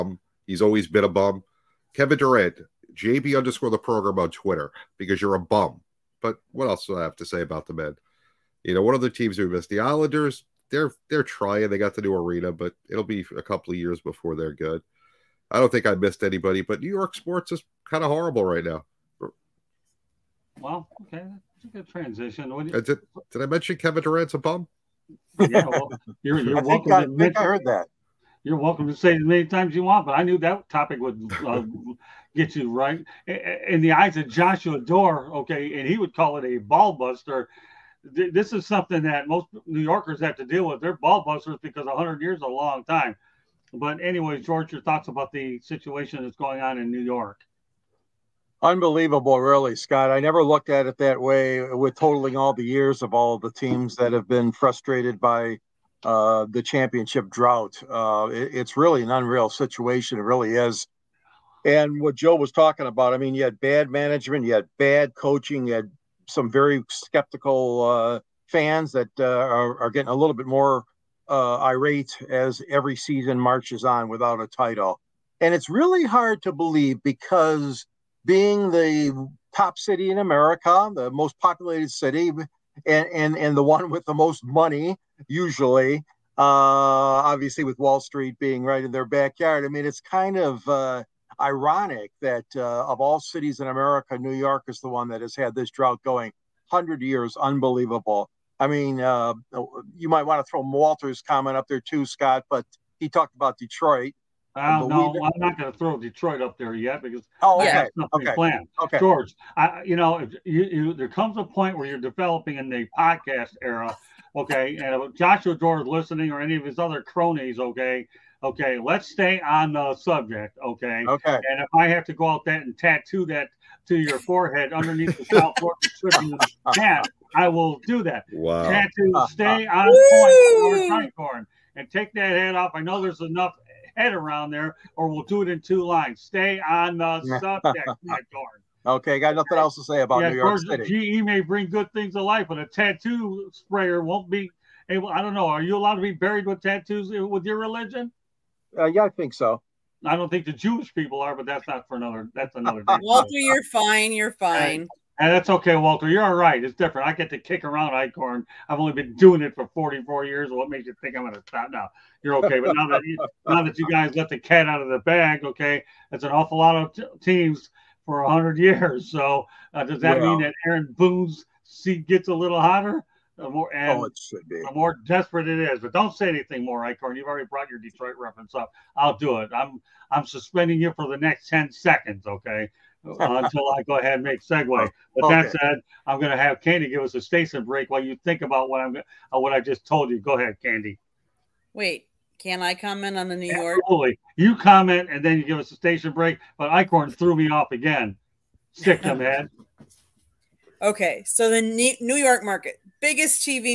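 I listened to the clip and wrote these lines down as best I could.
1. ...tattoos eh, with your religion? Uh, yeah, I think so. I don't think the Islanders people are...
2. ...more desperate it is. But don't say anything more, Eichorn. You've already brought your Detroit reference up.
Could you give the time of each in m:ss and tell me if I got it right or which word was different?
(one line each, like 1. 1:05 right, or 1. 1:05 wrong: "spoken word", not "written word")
1. 2:26 wrong: "Jewish", not "Islanders"
2. 2:54 right.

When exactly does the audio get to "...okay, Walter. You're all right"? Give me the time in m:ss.
2:35.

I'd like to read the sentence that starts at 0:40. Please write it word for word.
They're ball busters because 100 years is a long time.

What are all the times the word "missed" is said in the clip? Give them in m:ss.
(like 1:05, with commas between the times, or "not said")
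0:09, 0:15.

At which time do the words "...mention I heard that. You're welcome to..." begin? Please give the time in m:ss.
0:27.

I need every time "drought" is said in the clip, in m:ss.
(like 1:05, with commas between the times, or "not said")
0:57, 1:35.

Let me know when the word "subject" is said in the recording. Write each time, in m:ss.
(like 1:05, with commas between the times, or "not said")
1:59, 2:17.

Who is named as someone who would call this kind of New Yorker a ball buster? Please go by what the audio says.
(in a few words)
Joshua Dorr.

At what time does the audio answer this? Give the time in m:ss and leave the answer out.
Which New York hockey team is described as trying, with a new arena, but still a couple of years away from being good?
0:09.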